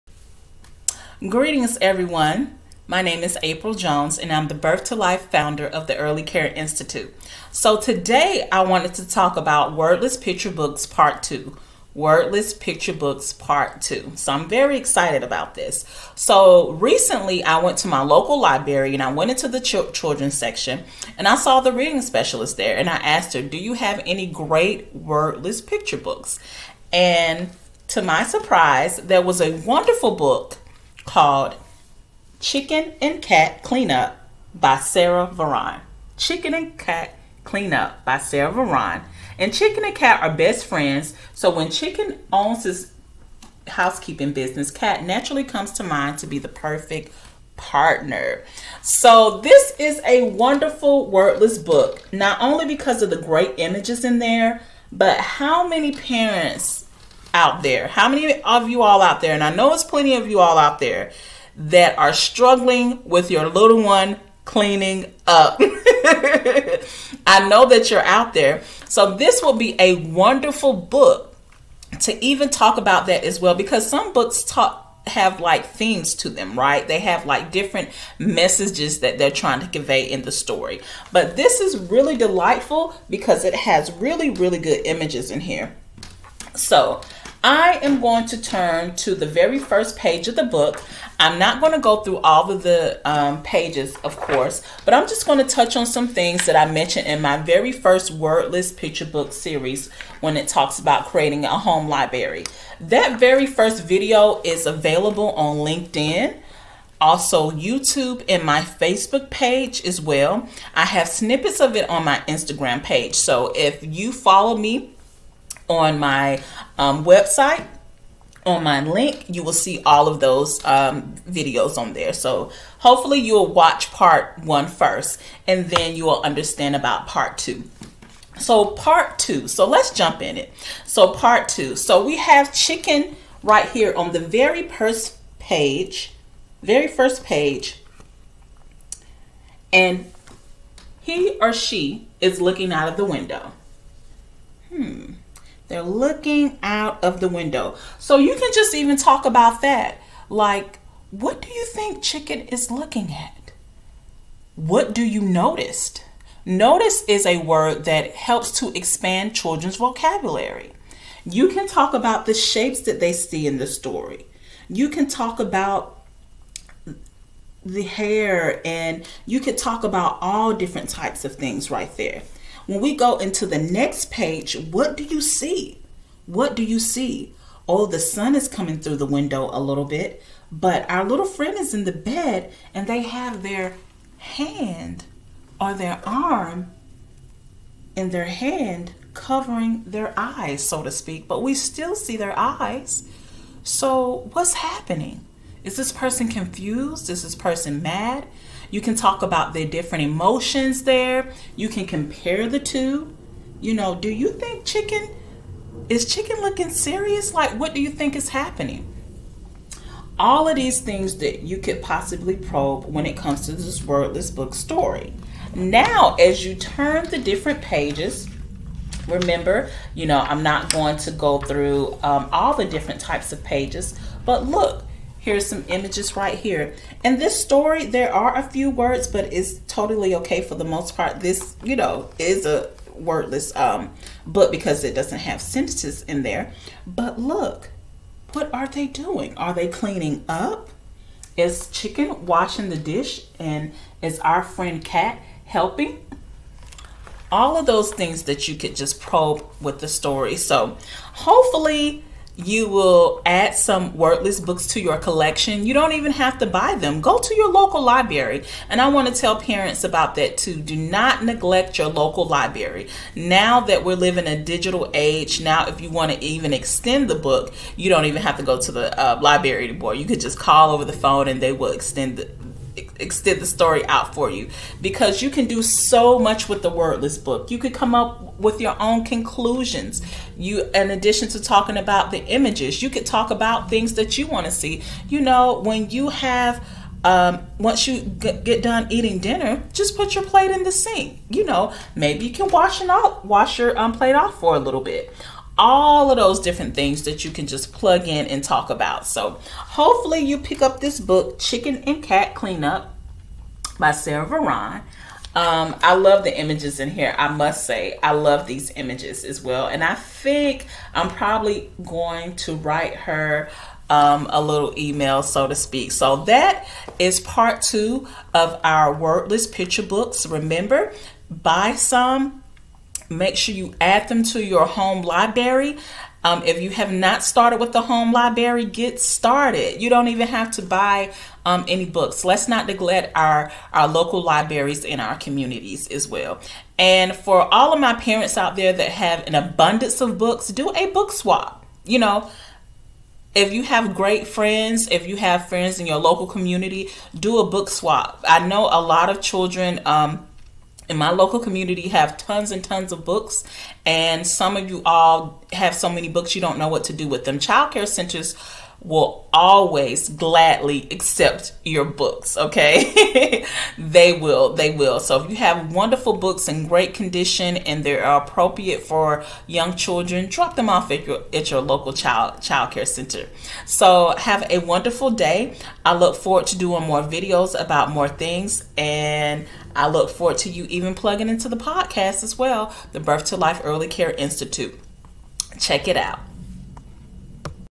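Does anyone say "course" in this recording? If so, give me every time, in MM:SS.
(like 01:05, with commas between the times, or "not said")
01:34.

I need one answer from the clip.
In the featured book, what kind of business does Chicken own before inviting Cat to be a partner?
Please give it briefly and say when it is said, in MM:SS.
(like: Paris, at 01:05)
housekeeping business, at 00:43.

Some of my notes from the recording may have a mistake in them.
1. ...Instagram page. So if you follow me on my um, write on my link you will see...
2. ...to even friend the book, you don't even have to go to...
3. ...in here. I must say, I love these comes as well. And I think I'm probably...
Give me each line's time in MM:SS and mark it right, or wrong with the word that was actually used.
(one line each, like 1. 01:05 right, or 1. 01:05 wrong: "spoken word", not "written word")
1. 01:52 wrong: "website", not "write"
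2. 04:26 wrong: "extend", not "friend"
3. 05:06 wrong: "images", not "comes".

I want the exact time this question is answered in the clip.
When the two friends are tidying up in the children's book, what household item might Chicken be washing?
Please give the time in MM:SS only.
04:02.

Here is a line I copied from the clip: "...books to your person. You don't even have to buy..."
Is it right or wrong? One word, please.
wrong.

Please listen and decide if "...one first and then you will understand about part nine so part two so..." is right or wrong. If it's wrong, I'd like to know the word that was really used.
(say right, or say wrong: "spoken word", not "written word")
wrong: "two", not "nine".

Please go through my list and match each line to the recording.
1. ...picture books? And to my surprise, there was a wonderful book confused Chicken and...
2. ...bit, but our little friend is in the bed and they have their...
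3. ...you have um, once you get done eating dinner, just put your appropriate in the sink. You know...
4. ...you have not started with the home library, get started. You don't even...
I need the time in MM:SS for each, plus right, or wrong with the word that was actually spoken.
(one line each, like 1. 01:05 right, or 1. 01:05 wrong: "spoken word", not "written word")
1. 00:25 wrong: "called", not "confused"
2. 02:59 right
3. 04:45 wrong: "plate", not "appropriate"
4. 05:26 right.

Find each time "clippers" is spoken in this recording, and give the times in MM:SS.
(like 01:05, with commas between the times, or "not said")
not said.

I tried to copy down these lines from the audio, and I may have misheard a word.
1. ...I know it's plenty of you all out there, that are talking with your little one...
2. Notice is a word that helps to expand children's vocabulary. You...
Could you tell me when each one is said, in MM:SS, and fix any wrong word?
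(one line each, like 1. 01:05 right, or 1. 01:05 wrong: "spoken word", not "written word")
1. 00:59 wrong: "struggling", not "talking"
2. 02:36 right.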